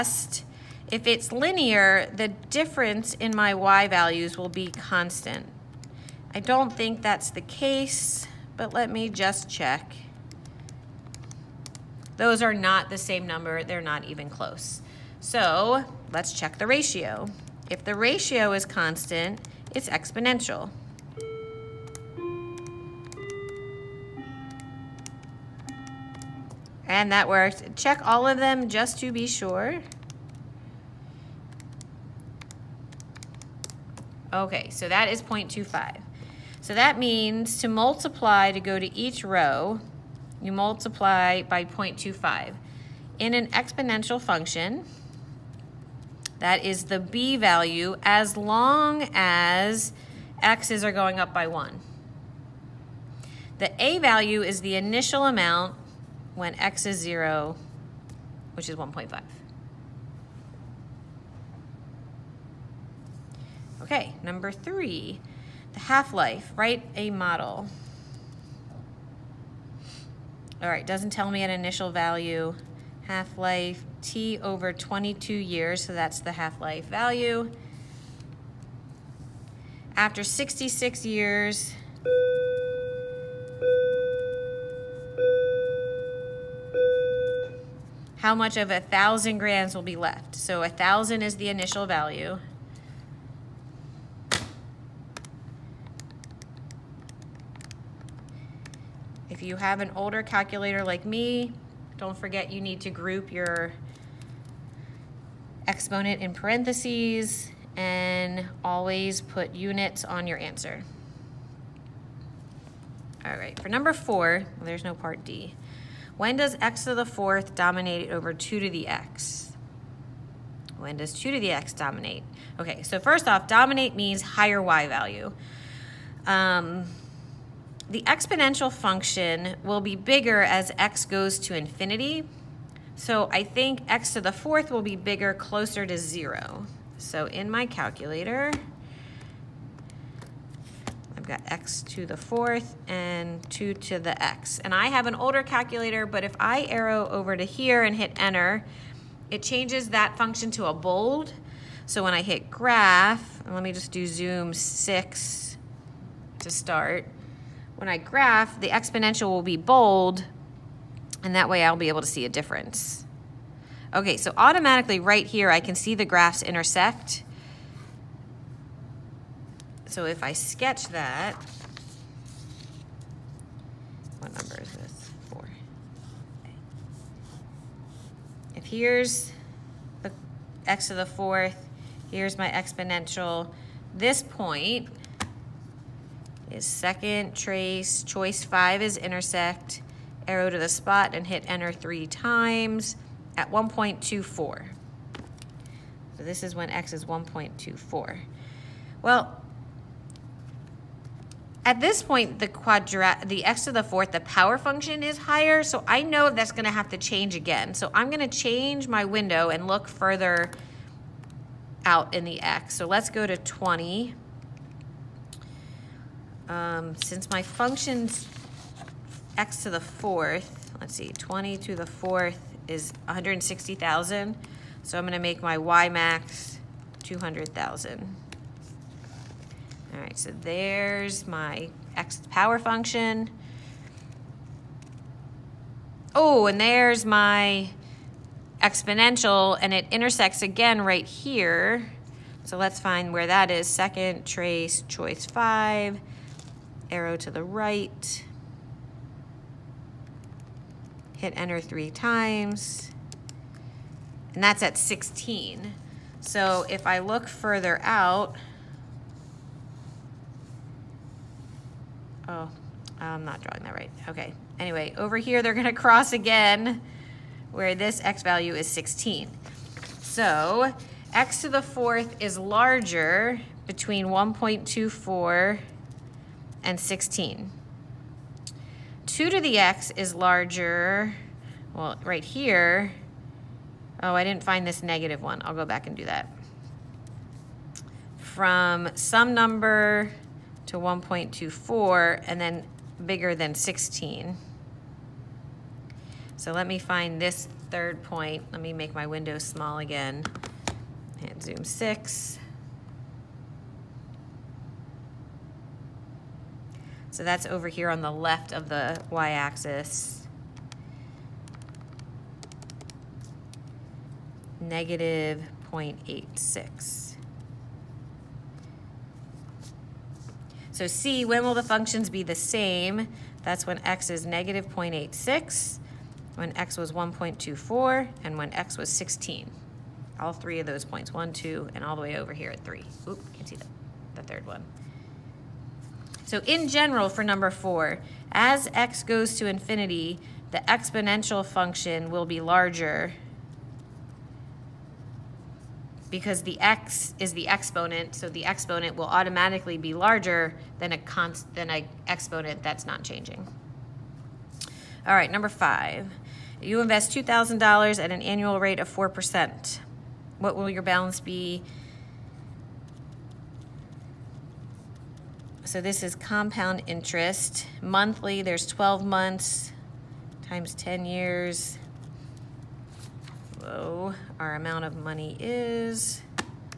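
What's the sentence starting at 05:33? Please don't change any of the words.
Oop, can't see the, the third one.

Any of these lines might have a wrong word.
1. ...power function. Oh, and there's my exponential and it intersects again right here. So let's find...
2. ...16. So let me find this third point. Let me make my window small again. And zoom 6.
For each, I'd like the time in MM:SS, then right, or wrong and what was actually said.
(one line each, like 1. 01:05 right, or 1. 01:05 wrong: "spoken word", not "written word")
1. 03:52 right
2. 04:53 right.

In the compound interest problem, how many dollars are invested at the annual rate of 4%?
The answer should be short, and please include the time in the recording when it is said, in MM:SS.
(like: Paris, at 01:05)
$2,000, at 05:57.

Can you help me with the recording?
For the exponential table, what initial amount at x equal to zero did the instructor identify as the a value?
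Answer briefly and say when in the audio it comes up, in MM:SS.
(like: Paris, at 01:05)
1.5, at 00:58.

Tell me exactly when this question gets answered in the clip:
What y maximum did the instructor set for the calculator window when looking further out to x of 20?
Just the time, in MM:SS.
03:47.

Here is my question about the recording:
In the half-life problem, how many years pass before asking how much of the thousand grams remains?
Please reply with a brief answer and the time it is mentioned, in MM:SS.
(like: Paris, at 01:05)
66 years, at 01:20.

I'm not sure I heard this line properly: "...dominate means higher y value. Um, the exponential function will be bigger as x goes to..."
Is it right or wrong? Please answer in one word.
right.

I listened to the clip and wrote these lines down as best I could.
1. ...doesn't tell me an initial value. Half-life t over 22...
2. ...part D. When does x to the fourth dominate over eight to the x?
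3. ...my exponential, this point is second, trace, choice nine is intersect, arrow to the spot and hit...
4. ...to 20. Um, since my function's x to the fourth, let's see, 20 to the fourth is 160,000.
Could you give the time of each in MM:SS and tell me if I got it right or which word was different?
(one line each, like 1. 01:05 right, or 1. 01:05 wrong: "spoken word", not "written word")
1. 01:10 right
2. 01:54 wrong: "two", not "eight"
3. 03:02 wrong: "five", not "nine"
4. 03:33 right.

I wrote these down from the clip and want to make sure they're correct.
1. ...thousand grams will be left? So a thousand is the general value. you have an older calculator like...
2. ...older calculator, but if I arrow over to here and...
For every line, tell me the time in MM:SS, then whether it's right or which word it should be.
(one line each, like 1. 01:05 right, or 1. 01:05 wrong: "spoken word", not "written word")
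1. 01:28 wrong: "initial", not "general"
2. 02:25 right.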